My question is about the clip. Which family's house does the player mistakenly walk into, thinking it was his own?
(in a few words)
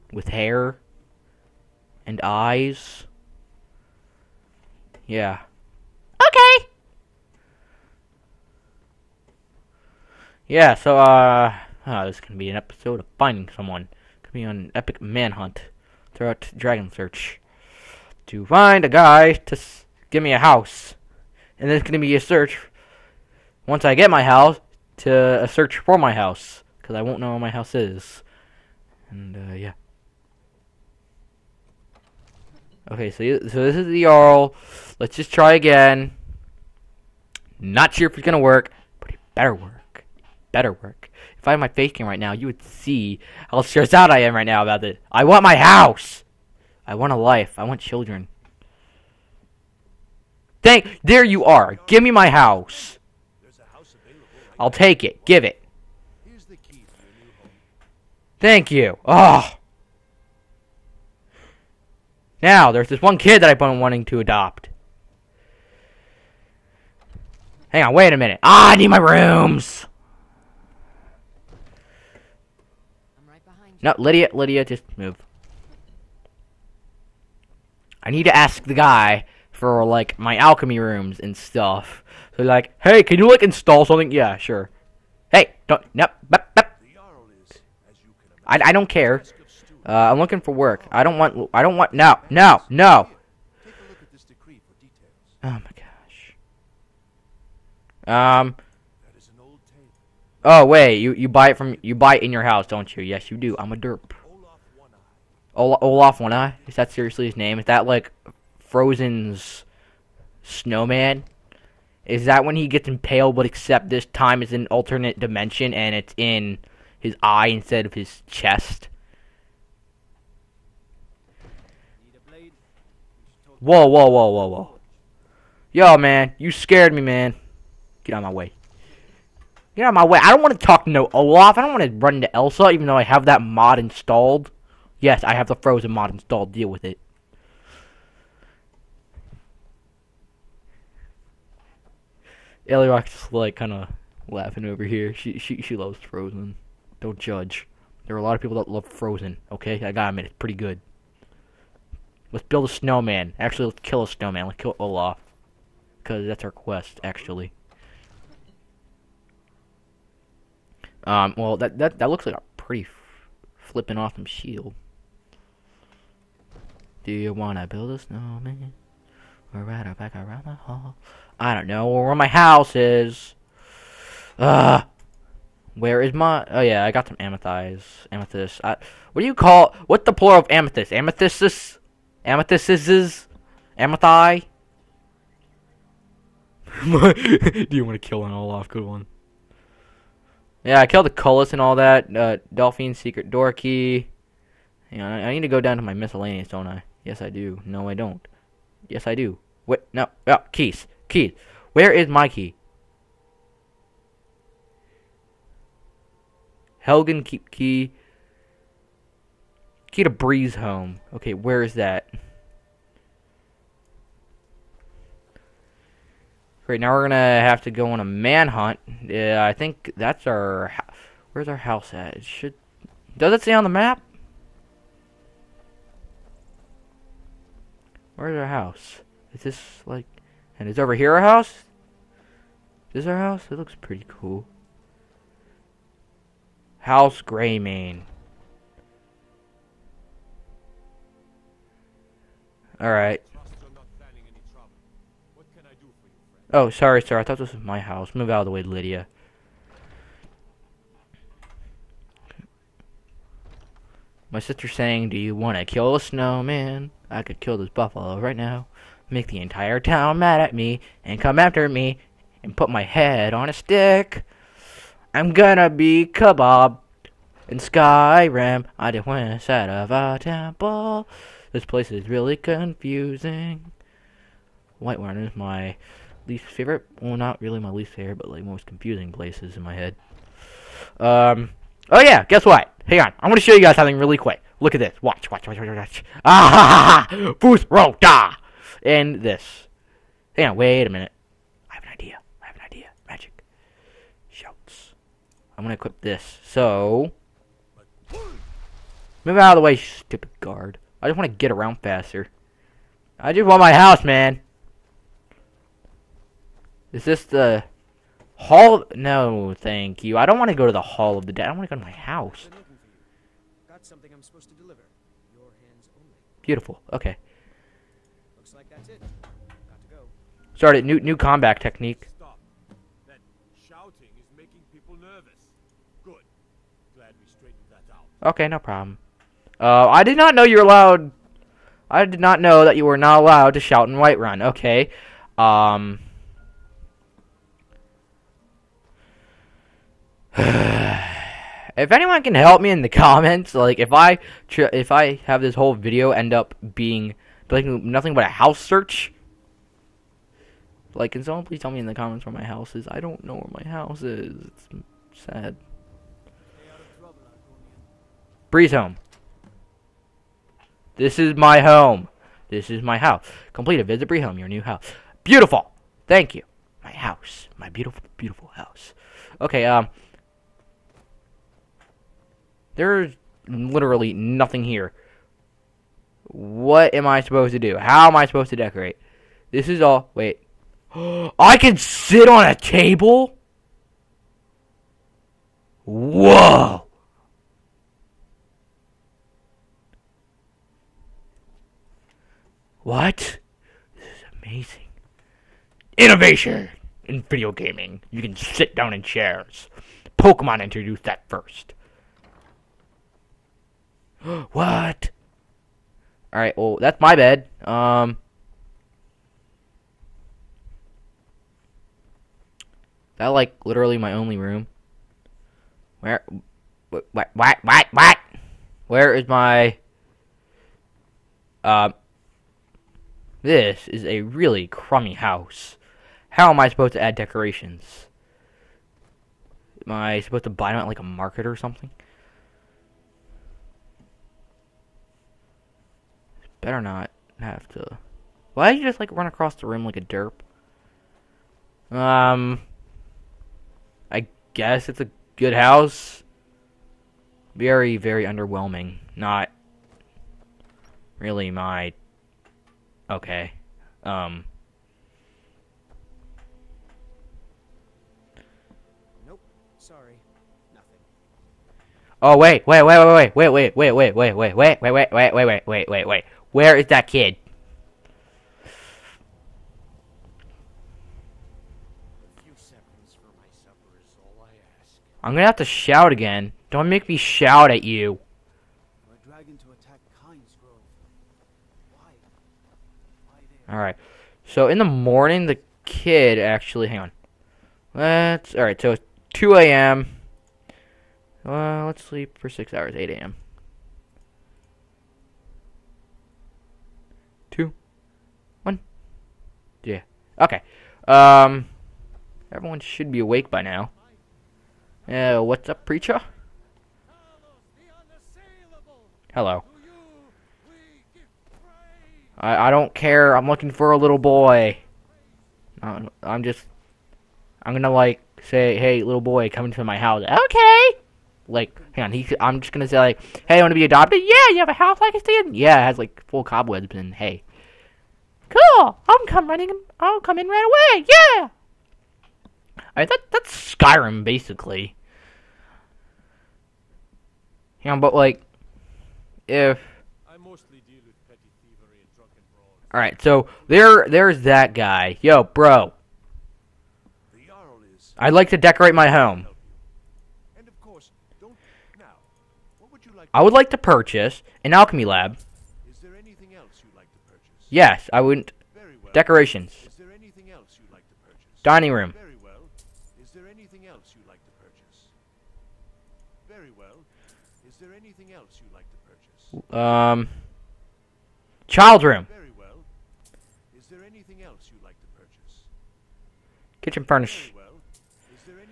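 House Greymane.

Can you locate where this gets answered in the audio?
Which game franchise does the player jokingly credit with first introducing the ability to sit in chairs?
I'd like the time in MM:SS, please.
06:40.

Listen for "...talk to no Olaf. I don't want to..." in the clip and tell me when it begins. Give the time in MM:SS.
02:10.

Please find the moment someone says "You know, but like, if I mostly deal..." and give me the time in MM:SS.
08:57.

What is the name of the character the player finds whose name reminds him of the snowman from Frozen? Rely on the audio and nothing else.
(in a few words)
Olaf One Eye.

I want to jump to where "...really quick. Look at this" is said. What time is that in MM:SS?
04:43.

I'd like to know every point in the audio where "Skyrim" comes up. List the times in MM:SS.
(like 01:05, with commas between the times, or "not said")
04:27, 08:53.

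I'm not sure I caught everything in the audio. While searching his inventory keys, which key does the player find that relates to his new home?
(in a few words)
Key to Breeze Home.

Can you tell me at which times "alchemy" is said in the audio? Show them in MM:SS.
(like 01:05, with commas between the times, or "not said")
01:20, 09:14.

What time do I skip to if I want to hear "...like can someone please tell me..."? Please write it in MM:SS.
05:50.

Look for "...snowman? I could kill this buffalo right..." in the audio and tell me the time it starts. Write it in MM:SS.
04:15.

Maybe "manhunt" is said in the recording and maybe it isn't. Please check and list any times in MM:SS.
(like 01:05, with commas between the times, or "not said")
00:14, 03:38.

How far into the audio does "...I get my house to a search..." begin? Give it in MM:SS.
00:23.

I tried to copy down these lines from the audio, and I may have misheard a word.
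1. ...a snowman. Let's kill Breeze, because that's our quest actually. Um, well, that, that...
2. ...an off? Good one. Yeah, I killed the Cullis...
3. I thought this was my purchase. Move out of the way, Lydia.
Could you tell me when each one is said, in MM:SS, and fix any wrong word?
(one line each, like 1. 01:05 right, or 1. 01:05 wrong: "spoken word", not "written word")
1. 02:34 wrong: "Olaf", not "Breeze"
2. 03:08 right
3. 04:07 wrong: "house", not "purchase".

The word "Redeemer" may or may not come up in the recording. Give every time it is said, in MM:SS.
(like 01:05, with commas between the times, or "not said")
not said.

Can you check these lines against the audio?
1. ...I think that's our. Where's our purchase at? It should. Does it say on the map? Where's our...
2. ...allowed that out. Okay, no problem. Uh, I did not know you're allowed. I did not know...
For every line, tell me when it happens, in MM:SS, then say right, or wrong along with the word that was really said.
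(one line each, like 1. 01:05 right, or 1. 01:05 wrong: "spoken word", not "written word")
1. 03:39 wrong: "house", not "purchase"
2. 05:27 wrong: "straightened", not "allowed".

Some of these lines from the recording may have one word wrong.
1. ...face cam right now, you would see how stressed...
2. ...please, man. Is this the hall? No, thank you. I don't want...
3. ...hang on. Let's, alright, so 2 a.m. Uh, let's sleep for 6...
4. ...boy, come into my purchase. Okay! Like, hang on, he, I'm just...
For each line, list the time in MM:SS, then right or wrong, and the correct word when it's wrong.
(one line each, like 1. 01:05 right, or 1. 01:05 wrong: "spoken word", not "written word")
1. 00:41 right
2. 05:03 wrong: "house", not "please"
3. 08:06 right
4. 08:39 wrong: "house", not "purchase".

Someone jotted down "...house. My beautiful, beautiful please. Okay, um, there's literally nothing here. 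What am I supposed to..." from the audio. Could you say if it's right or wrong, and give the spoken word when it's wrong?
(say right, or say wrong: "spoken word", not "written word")
wrong: "house", not "please".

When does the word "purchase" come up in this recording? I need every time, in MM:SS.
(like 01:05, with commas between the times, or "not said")
09:13, 09:24, 09:29, 09:35.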